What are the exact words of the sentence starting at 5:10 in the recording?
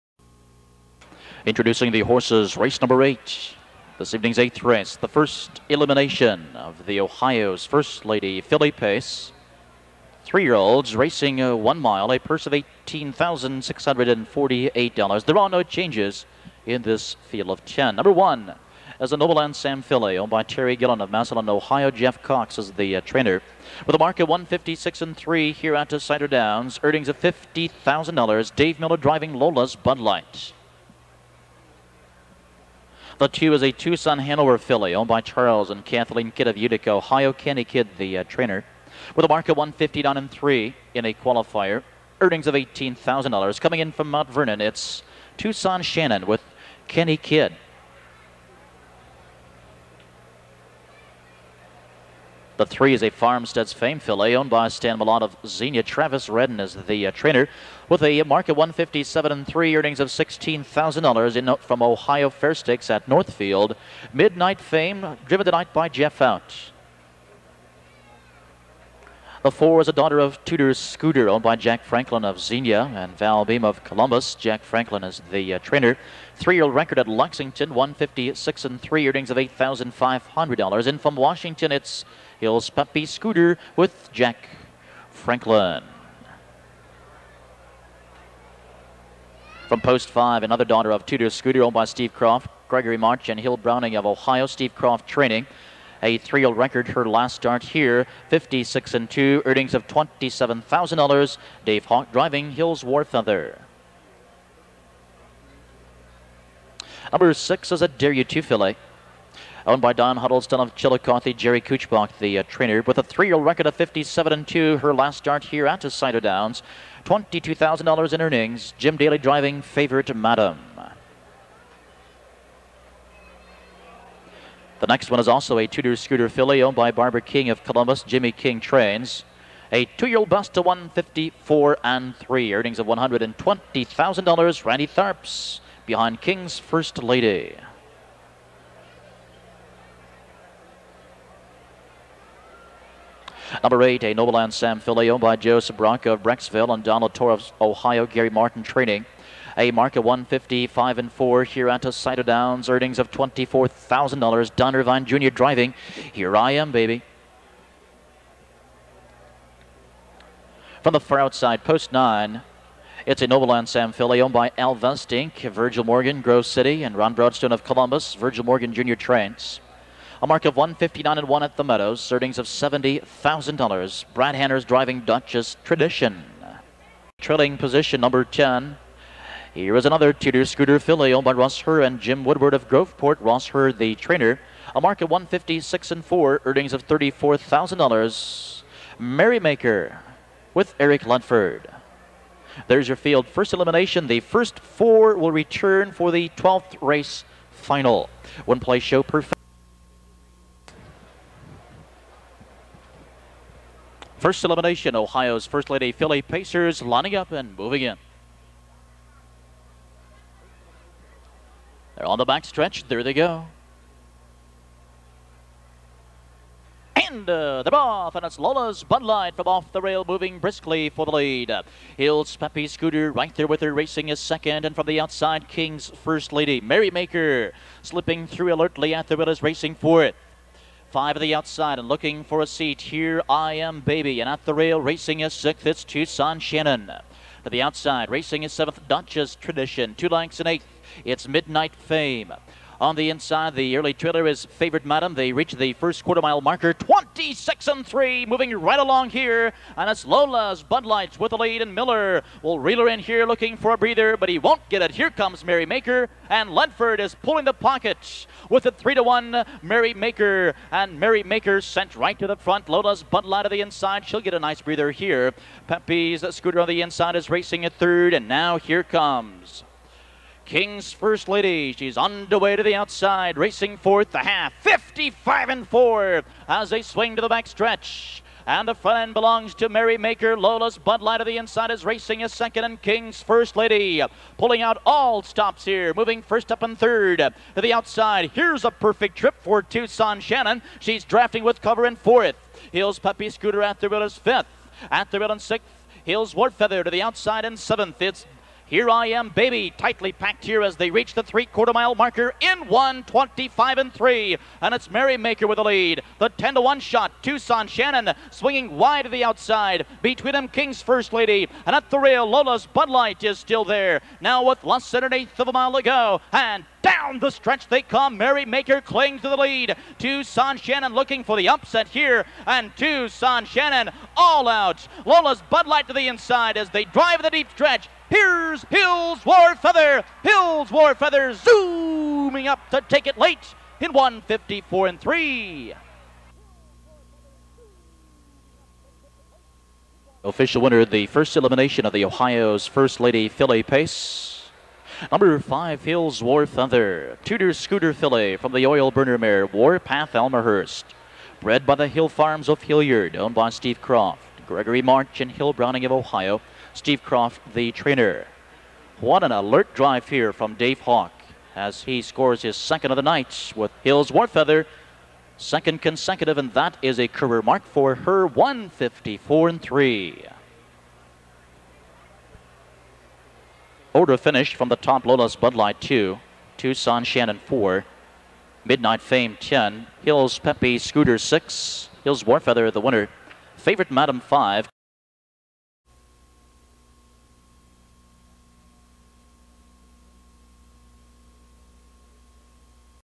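Between them, King's First Lady, and at the rail, Lola's Bud Light is still there.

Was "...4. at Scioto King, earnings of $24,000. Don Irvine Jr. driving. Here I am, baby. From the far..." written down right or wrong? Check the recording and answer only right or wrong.
wrong.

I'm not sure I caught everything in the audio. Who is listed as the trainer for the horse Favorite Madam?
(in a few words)
Jerry Kuchbach.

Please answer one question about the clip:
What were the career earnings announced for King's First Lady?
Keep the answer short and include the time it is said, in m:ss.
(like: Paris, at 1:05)
$120,000, at 2:12.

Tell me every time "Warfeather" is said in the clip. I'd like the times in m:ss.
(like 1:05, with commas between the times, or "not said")
6:04, 6:22.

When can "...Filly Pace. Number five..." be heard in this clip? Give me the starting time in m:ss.
5:43.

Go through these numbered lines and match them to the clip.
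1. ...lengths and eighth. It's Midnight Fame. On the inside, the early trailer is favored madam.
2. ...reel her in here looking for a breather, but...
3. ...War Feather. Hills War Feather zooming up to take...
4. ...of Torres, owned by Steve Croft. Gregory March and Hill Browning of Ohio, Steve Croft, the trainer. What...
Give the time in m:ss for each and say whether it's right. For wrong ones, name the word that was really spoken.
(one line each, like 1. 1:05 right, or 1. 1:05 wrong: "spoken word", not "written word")
1. 4:00 right
2. 4:12 right
3. 5:29 right
4. 5:52 wrong: "Hilliard", not "Torres".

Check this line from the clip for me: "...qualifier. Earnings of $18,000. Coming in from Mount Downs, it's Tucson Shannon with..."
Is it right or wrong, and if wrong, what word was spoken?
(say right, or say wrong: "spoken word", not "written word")
wrong: "Vernon", not "Downs".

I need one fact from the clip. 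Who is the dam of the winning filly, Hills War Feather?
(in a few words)
Warpath Almahurst.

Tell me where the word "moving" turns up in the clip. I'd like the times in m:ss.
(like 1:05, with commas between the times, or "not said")
3:27, 3:40, 4:08, 4:45.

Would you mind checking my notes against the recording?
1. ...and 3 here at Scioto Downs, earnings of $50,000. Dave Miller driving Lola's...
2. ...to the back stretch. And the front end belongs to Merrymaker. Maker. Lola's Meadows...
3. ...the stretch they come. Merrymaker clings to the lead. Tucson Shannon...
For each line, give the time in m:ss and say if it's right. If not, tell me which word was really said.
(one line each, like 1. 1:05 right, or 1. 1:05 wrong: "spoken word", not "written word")
1. 0:25 right
2. 4:37 wrong: "Bud", not "Meadows"
3. 5:17 right.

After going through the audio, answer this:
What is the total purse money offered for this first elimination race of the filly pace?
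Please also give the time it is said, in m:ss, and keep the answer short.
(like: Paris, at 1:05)
$18,648, at 0:12.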